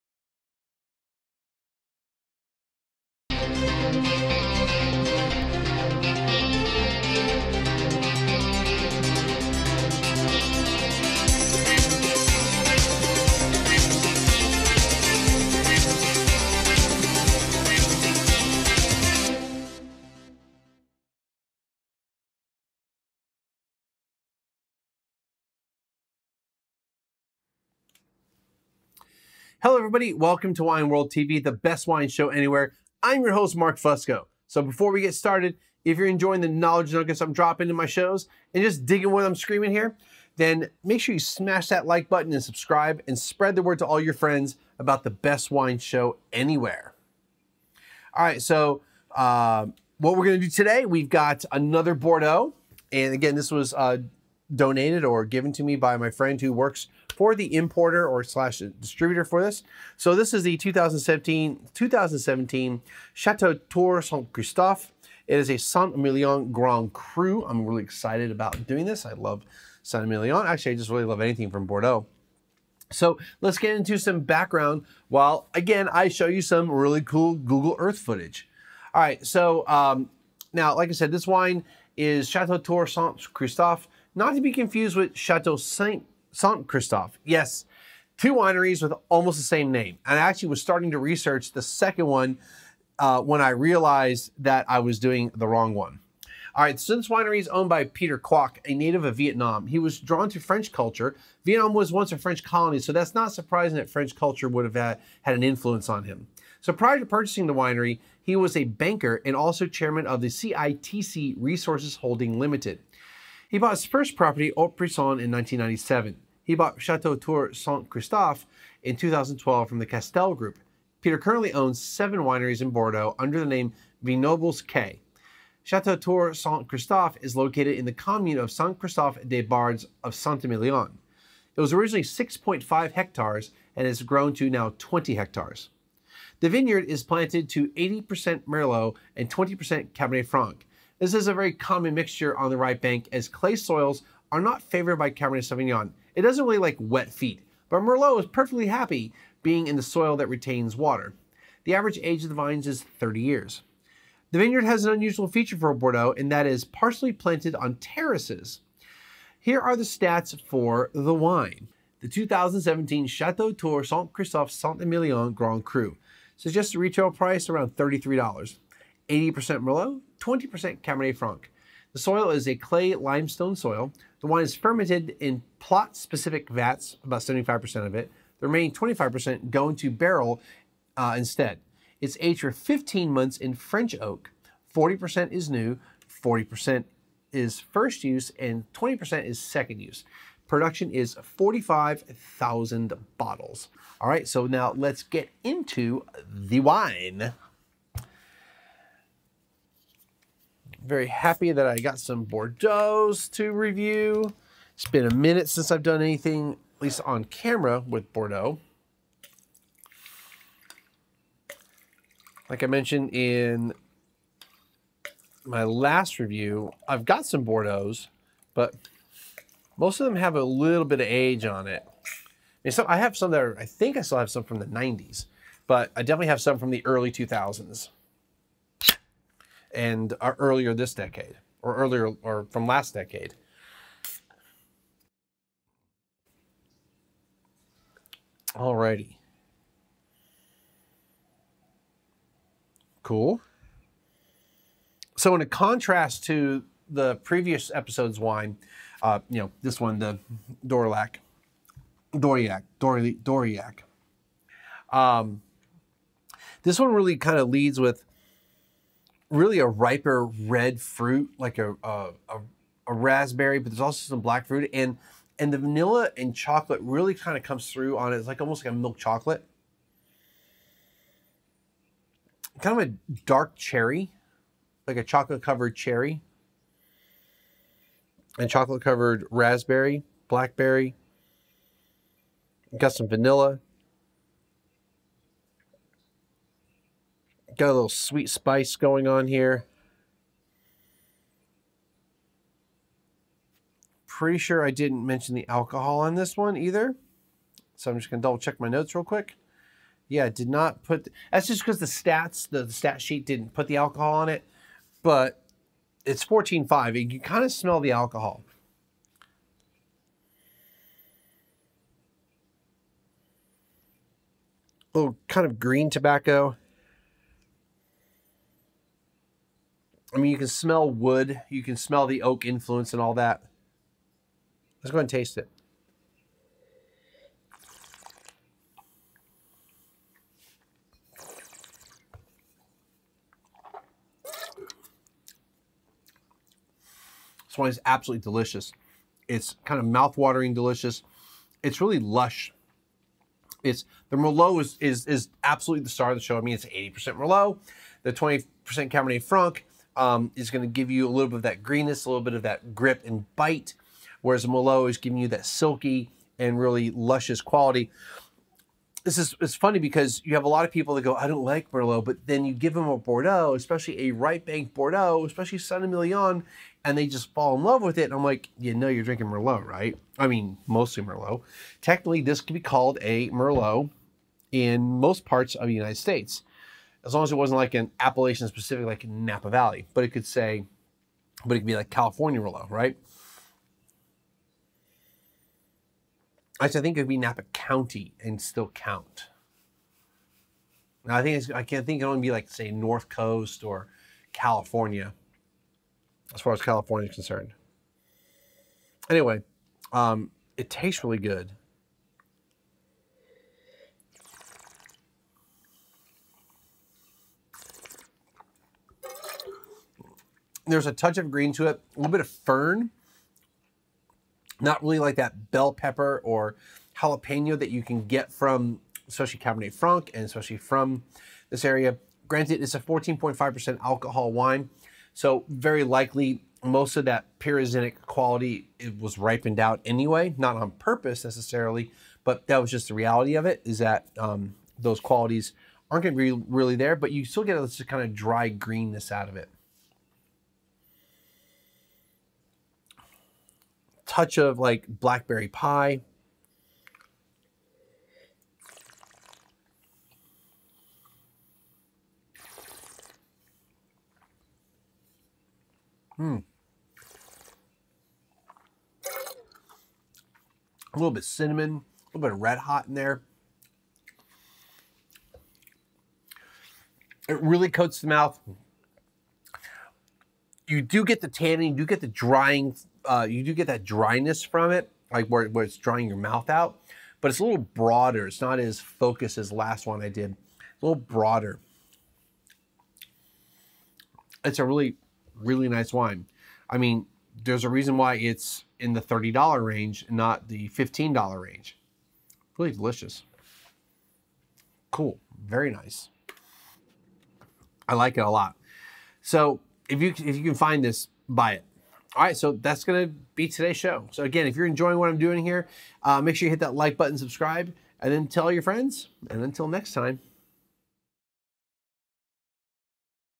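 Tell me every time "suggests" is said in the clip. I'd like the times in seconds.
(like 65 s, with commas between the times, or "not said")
166 s.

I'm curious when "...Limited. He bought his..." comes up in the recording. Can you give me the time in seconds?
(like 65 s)
112 s.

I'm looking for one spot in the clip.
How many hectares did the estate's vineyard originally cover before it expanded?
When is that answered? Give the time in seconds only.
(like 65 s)
132 s.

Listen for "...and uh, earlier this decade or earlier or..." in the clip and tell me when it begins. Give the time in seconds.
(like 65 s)
229 s.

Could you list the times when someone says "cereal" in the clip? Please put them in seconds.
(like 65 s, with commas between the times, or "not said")
not said.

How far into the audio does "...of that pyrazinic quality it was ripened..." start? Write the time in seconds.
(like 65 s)
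426 s.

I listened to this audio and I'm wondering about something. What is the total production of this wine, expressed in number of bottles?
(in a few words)
45,000 bottles.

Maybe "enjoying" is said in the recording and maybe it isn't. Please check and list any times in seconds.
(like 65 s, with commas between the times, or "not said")
36 s, 504 s.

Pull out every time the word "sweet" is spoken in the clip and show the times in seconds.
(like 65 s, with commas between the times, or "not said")
287 s.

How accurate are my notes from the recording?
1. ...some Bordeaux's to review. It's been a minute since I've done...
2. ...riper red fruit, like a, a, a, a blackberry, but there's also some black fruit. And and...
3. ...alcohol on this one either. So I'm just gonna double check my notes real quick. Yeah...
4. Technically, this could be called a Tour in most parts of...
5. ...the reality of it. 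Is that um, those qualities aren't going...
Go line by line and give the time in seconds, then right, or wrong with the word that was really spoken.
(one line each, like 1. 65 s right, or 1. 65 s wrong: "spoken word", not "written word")
1. 201 s right
2. 259 s wrong: "raspberry", not "blackberry"
3. 295 s right
4. 371 s wrong: "Merlot", not "Tour"
5. 432 s right.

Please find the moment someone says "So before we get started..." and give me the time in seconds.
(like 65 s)
34 s.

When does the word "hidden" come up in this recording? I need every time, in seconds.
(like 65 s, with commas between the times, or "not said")
not said.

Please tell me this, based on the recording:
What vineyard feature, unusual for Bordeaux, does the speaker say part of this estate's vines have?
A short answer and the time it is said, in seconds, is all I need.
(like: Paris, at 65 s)
Terraces, at 157 s.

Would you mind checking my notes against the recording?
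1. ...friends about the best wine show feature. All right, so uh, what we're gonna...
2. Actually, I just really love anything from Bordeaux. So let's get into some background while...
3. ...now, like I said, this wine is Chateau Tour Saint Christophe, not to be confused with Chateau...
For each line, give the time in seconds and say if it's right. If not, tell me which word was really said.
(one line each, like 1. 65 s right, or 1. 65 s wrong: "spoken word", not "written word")
1. 44 s wrong: "anywhere", not "feature"
2. 70 s right
3. 80 s right.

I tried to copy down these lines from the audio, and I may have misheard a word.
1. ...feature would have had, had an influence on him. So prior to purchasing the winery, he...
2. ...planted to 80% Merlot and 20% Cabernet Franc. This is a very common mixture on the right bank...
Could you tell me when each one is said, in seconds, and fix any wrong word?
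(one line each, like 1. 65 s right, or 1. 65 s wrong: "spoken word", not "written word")
1. 104 s wrong: "culture", not "feature"
2. 137 s right.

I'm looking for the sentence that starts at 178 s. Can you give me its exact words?
The remaining 25% go into barrel uh, instead.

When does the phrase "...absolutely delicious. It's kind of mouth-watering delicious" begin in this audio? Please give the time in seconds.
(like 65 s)
337 s.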